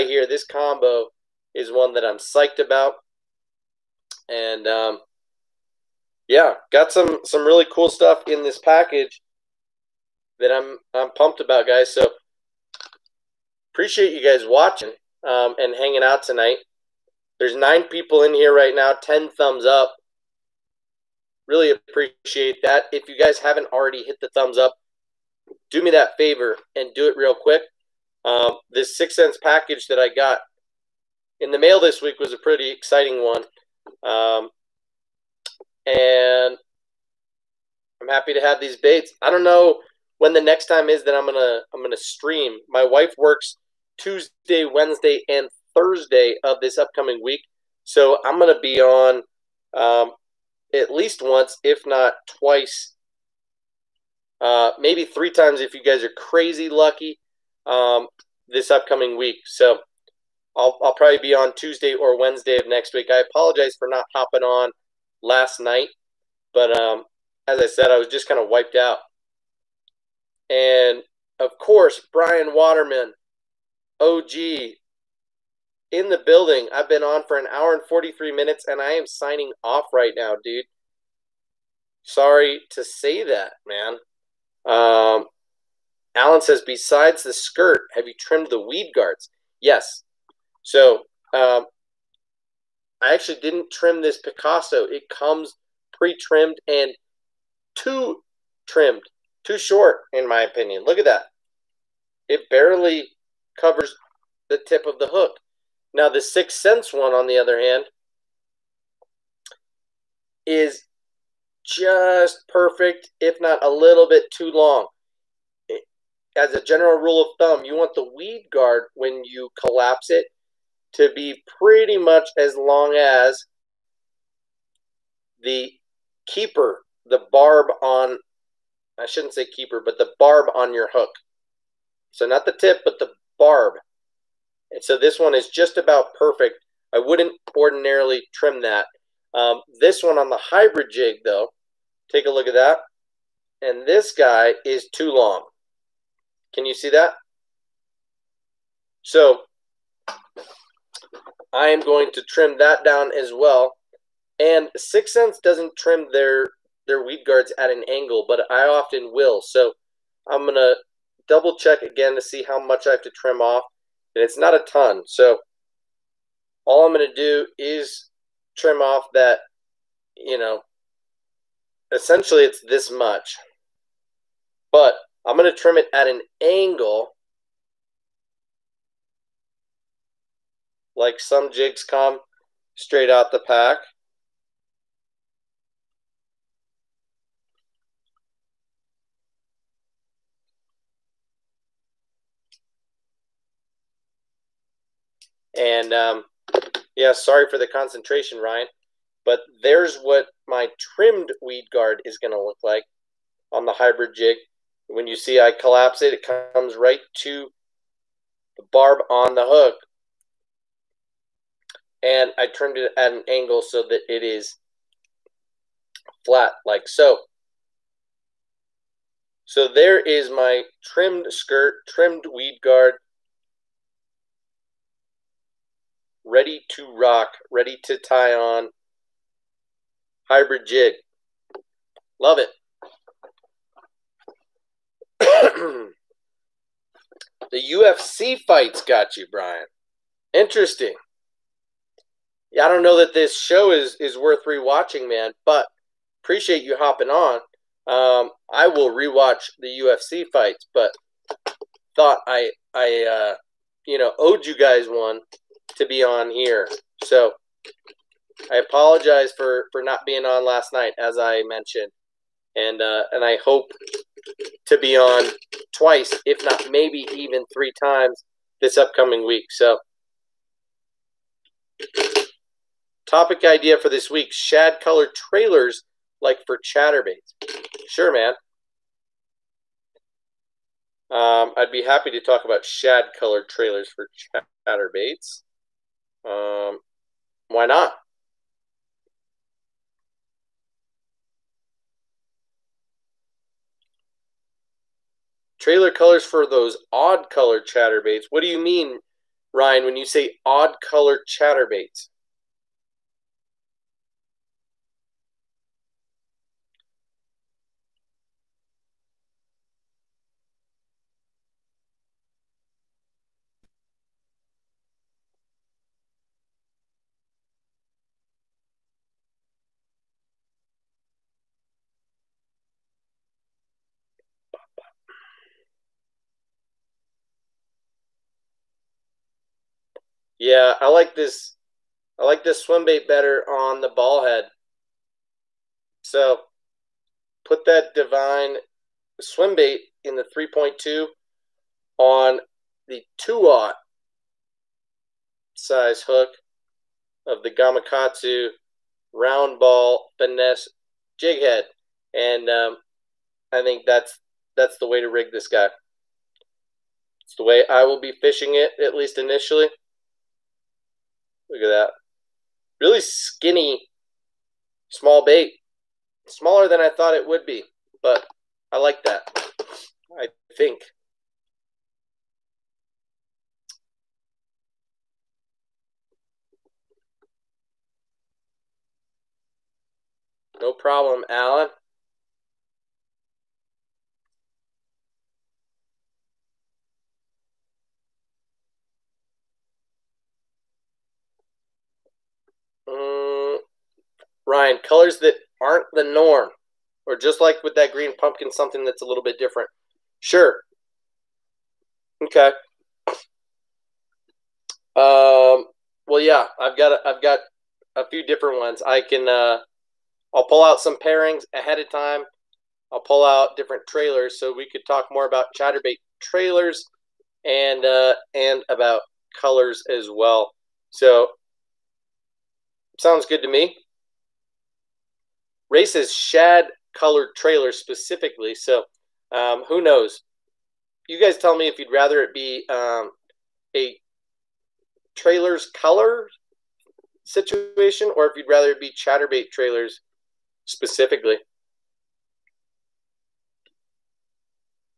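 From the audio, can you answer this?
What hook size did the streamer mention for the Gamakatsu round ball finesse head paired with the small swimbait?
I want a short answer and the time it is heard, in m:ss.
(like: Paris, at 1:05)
2/0, at 5:43.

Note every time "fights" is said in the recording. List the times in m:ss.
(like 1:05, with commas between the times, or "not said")
3:58, 4:10.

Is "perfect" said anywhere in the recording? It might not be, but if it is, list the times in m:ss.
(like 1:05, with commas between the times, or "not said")
1:52, 2:16.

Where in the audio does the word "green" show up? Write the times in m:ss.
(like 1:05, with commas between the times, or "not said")
6:37.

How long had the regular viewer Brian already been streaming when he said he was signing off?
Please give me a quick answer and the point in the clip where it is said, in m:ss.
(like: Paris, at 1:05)
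1 hour 43 minutes, at 1:17.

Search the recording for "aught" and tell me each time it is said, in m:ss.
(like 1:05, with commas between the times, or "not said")
5:43.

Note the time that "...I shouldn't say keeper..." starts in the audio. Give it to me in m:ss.
2:08.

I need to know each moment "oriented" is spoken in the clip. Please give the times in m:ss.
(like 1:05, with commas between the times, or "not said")
not said.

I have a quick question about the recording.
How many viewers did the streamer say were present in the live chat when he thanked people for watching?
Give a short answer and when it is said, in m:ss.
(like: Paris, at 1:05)
9, at 0:17.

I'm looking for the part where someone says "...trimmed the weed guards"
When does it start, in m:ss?
1:28.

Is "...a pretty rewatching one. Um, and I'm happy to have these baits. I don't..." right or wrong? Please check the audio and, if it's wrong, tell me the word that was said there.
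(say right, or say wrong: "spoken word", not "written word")
wrong: "exciting", not "rewatching".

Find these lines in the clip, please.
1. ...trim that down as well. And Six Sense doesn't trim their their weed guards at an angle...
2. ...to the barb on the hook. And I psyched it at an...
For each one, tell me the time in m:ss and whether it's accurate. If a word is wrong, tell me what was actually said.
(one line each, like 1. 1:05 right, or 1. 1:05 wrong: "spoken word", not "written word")
1. 2:32 right
2. 3:27 wrong: "trimmed", not "psyched".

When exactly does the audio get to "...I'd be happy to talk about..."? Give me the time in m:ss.
4:41.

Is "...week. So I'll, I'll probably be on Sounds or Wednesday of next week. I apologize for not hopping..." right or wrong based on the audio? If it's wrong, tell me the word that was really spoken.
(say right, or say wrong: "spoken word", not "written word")
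wrong: "Tuesday", not "Sounds".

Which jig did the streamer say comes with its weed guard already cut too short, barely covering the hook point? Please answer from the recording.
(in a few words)
Picasso.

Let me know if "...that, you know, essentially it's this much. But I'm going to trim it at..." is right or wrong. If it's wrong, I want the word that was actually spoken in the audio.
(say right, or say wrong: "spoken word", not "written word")
right.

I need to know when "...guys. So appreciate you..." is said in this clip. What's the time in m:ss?
0:11.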